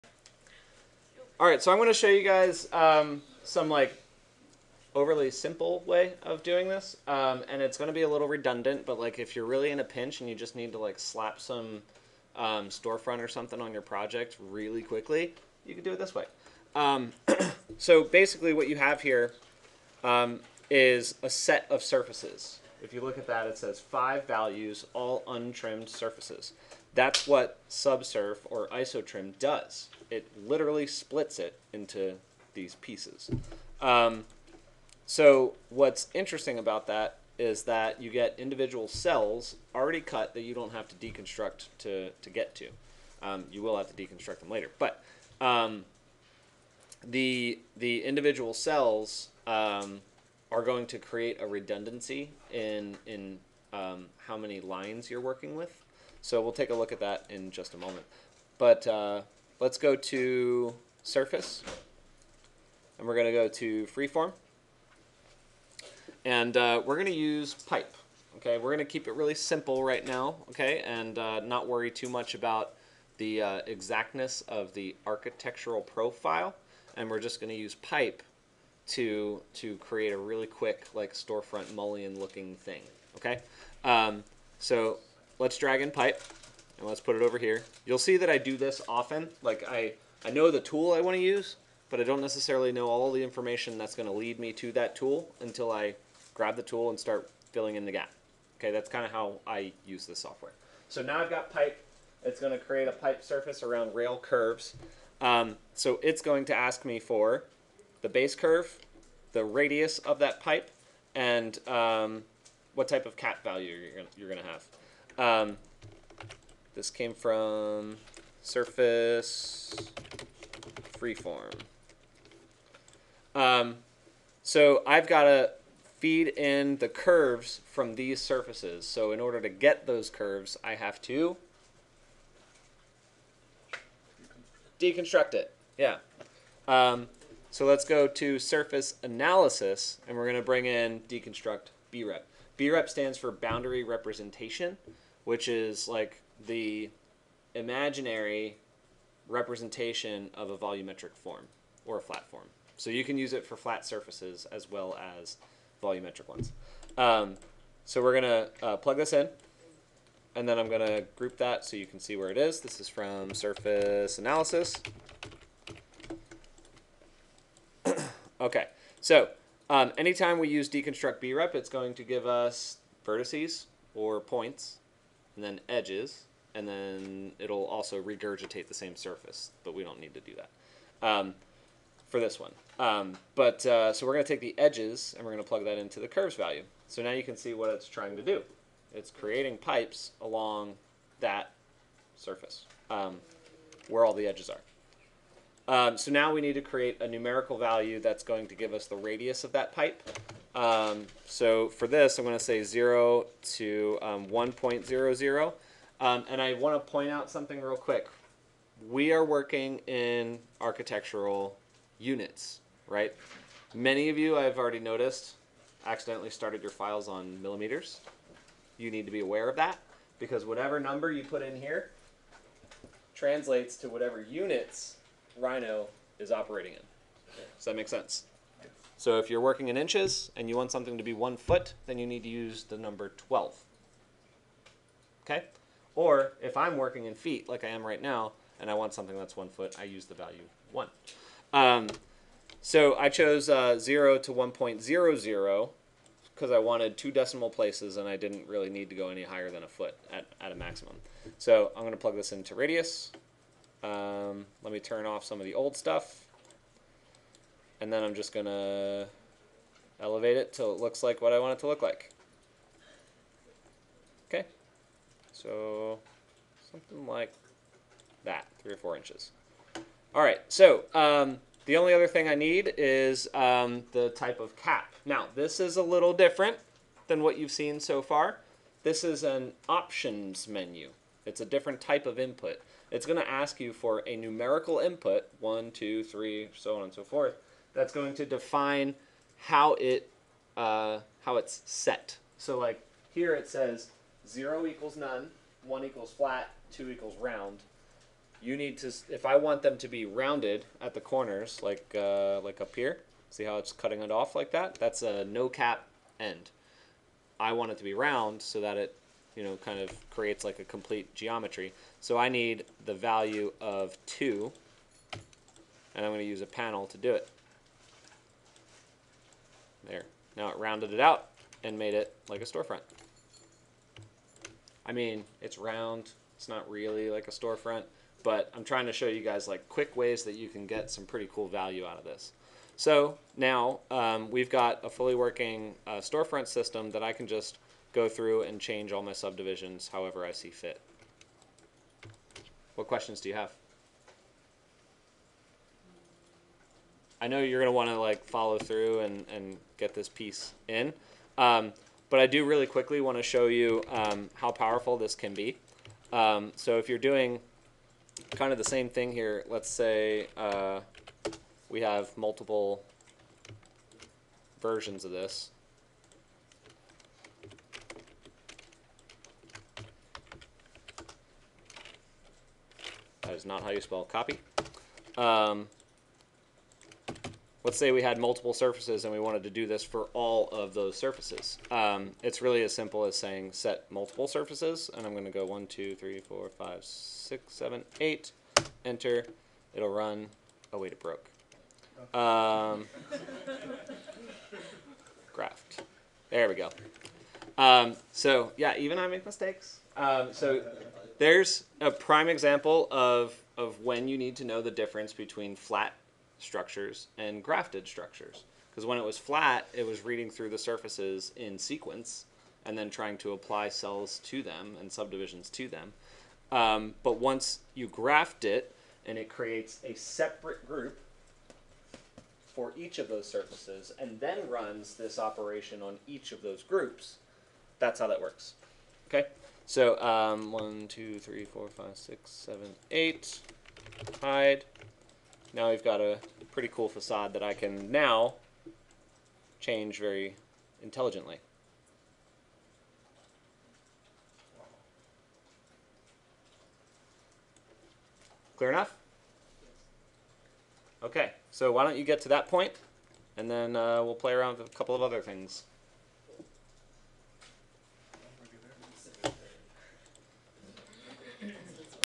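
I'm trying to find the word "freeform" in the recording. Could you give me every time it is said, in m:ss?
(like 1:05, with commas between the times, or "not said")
1:03, 2:00.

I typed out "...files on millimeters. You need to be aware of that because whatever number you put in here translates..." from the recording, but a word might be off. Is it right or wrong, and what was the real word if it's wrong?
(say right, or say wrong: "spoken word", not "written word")
right.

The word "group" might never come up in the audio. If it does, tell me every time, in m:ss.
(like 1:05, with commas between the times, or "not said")
2:41, 7:00, 7:06.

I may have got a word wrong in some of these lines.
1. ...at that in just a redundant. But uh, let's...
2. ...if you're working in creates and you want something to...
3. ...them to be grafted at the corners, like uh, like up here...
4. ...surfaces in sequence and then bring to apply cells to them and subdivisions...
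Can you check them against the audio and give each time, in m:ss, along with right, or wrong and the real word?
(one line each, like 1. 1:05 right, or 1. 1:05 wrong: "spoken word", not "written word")
1. 0:56 wrong: "moment", not "redundant"
2. 3:49 wrong: "inches", not "creates"
3. 4:59 wrong: "rounded", not "grafted"
4. 6:50 wrong: "trying", not "bring".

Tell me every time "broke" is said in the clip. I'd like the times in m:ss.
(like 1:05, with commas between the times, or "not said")
6:30.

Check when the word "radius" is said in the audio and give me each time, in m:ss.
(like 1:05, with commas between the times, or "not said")
1:49, 3:18, 4:12.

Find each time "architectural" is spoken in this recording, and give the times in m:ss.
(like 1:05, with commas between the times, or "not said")
1:15, 3:30.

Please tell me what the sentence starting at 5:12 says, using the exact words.
So I need the value of 2, and I'm going to use a panel to do it.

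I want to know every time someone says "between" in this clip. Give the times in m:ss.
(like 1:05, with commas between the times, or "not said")
6:45.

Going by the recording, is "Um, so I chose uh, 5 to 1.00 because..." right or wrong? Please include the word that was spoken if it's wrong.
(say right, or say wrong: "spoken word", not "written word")
wrong: "0", not "5".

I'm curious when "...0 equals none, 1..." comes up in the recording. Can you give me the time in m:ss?
4:54.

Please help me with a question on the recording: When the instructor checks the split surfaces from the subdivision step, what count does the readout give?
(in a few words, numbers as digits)
5.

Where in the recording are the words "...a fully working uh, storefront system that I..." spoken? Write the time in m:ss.
5:34.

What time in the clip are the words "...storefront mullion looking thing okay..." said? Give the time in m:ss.
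1:21.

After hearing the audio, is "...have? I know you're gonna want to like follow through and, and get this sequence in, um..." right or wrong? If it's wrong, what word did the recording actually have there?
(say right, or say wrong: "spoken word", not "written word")
wrong: "piece", not "sequence".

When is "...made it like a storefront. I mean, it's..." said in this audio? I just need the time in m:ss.
5:21.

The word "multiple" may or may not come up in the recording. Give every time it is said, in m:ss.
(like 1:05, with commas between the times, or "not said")
6:02, 6:18, 6:23.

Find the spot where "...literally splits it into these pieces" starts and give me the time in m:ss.
0:30.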